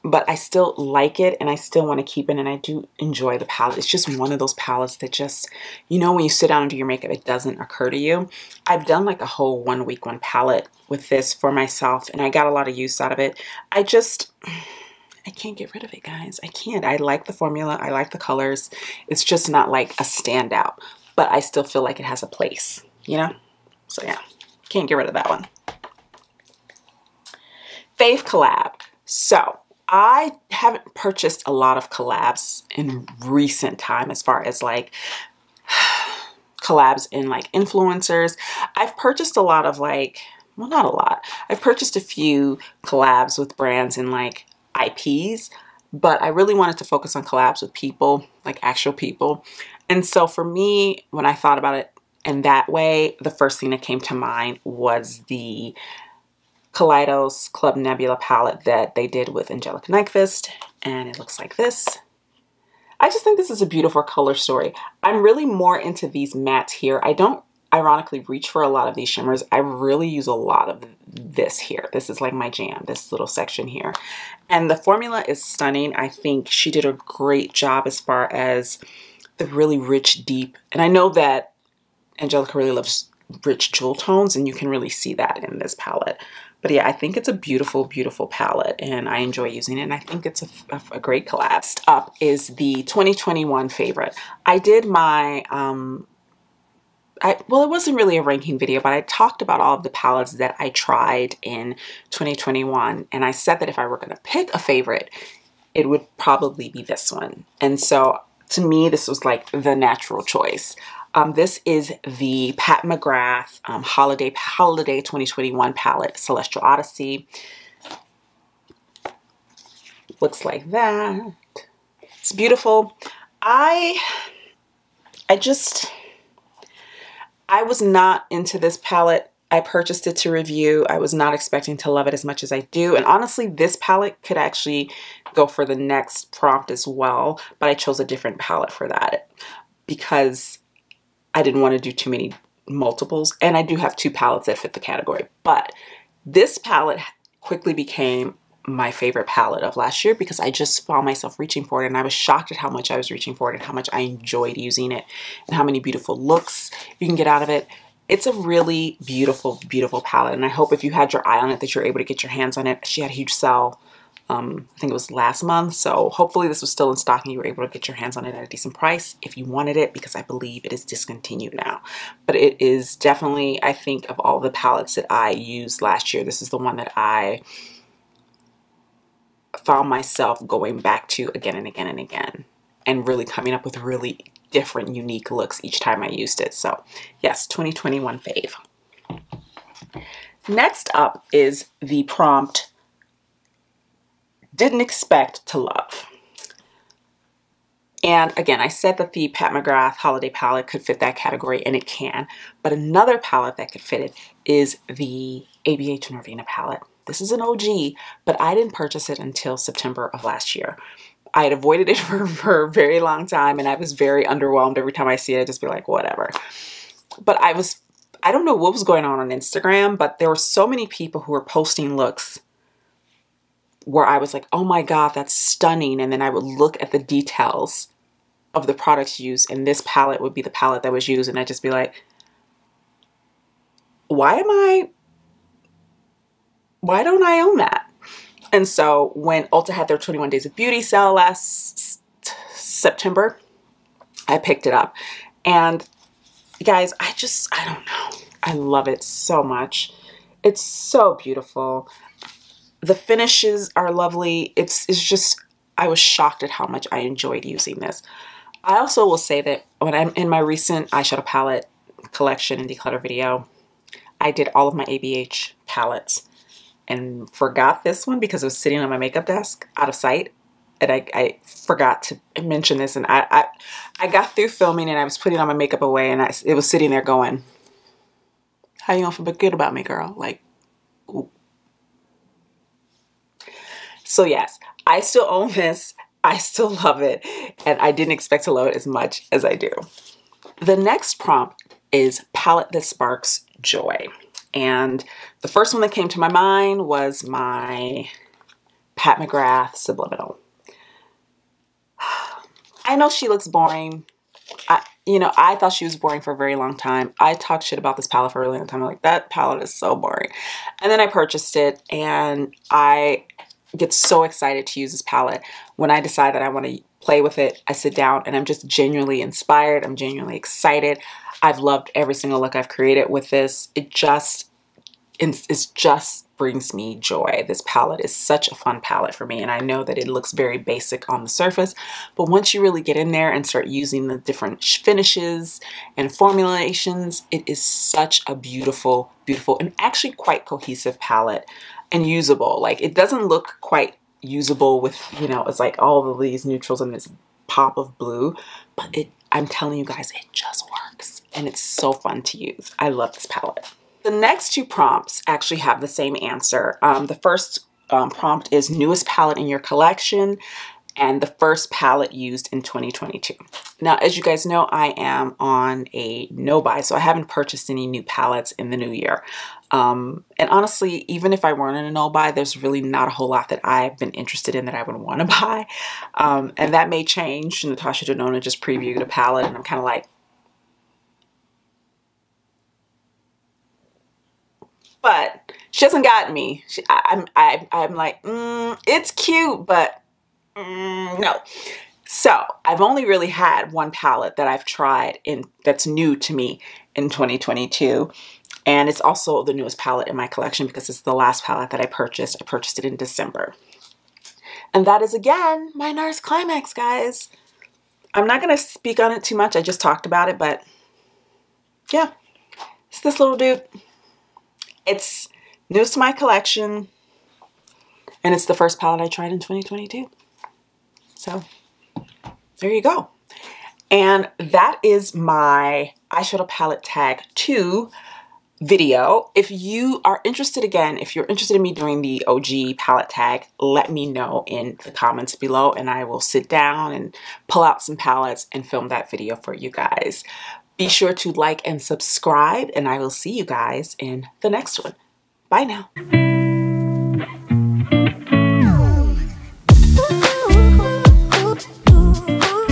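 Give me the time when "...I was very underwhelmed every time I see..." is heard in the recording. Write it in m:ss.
3:33.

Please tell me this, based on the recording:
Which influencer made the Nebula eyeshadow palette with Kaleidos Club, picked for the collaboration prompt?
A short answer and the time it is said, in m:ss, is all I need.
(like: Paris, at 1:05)
Angelica Nyqvist, at 0:59.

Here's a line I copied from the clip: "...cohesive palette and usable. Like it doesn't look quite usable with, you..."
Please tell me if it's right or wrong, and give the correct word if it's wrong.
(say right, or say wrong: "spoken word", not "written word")
right.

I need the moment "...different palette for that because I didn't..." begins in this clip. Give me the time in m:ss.
2:18.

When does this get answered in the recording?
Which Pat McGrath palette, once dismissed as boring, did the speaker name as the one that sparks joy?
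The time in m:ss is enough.
4:59.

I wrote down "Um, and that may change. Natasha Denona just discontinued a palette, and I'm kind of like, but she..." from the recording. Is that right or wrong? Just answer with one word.
wrong.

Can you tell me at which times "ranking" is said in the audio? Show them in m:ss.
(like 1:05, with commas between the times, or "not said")
1:38.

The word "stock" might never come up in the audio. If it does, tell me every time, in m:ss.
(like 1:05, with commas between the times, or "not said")
2:46.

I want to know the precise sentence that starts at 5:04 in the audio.
I, you know, I thought she was boring for a very long time.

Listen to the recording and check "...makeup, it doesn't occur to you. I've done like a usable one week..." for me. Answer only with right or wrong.
wrong.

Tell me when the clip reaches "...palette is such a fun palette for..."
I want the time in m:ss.
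5:27.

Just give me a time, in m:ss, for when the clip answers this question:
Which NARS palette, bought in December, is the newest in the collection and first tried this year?
6:45.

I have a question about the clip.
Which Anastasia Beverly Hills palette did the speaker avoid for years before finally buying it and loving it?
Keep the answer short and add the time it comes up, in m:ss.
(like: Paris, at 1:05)
Norvina, at 3:26.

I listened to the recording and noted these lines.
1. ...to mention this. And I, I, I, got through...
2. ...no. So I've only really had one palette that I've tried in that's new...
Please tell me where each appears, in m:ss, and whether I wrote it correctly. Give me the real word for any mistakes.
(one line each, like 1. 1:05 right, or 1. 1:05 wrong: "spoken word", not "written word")
1. 4:32 right
2. 6:31 right.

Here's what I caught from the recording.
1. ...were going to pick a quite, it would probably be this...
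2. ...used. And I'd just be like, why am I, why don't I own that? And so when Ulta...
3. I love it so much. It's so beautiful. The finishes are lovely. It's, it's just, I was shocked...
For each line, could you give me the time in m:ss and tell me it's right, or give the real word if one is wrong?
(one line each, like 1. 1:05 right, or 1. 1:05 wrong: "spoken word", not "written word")
1. 1:43 wrong: "favorite", not "quite"
2. 3:51 right
3. 4:08 right.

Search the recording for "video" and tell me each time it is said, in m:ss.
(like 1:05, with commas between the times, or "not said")
1:38, 4:23, 7:08, 7:19.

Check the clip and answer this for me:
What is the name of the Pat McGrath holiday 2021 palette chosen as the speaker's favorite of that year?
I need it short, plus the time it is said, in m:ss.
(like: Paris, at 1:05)
Celestial Odyssey, at 1:56.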